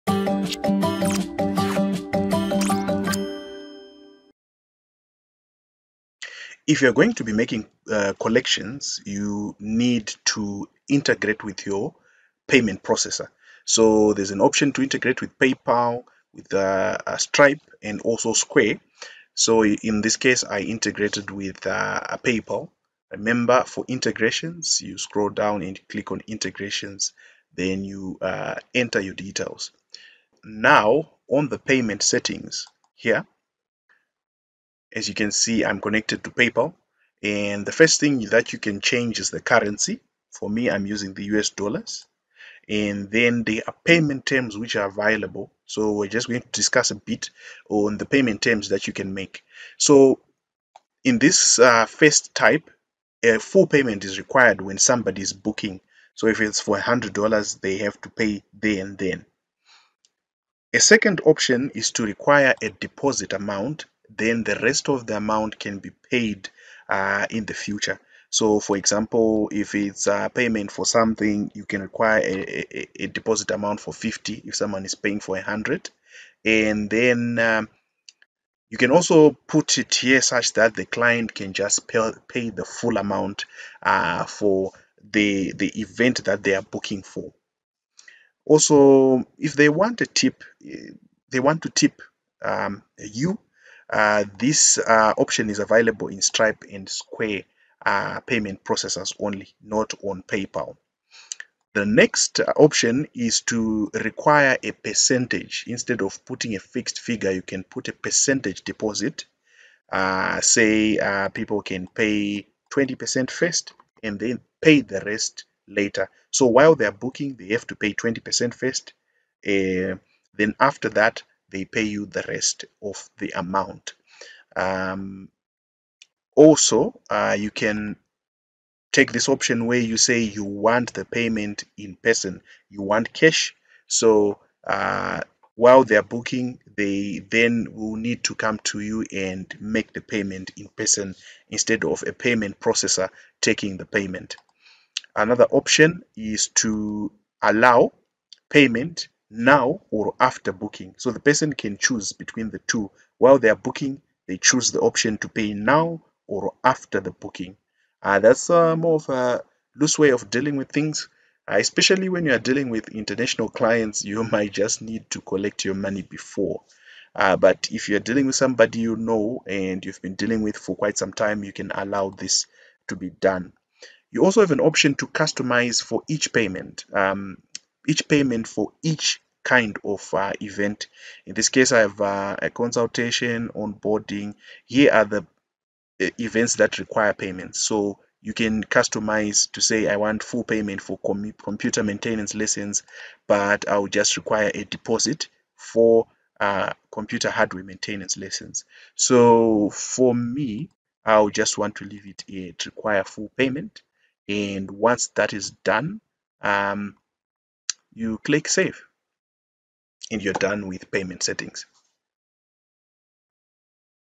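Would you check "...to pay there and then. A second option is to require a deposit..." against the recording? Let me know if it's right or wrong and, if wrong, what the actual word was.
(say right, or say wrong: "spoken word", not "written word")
right.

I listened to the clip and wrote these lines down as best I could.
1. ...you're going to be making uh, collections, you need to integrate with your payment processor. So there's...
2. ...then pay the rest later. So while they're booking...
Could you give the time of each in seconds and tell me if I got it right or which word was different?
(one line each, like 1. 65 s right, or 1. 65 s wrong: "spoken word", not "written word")
1. 6 s right
2. 114 s right.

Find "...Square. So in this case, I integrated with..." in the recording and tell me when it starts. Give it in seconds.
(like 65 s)
18 s.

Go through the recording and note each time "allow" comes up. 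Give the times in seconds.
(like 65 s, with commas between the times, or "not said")
147 s, 171 s.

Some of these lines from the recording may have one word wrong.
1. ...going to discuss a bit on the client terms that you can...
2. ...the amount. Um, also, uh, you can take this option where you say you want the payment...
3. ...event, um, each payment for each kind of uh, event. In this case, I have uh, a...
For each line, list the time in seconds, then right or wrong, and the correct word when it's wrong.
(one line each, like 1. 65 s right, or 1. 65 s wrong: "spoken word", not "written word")
1. 46 s wrong: "payment", not "client"
2. 123 s right
3. 176 s wrong: "payment", not "event".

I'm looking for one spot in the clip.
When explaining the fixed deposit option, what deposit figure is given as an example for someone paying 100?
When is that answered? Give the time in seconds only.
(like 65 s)
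73 s.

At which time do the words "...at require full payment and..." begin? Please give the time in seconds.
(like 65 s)
202 s.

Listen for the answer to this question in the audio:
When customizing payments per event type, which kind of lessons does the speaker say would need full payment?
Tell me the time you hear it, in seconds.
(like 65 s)
190 s.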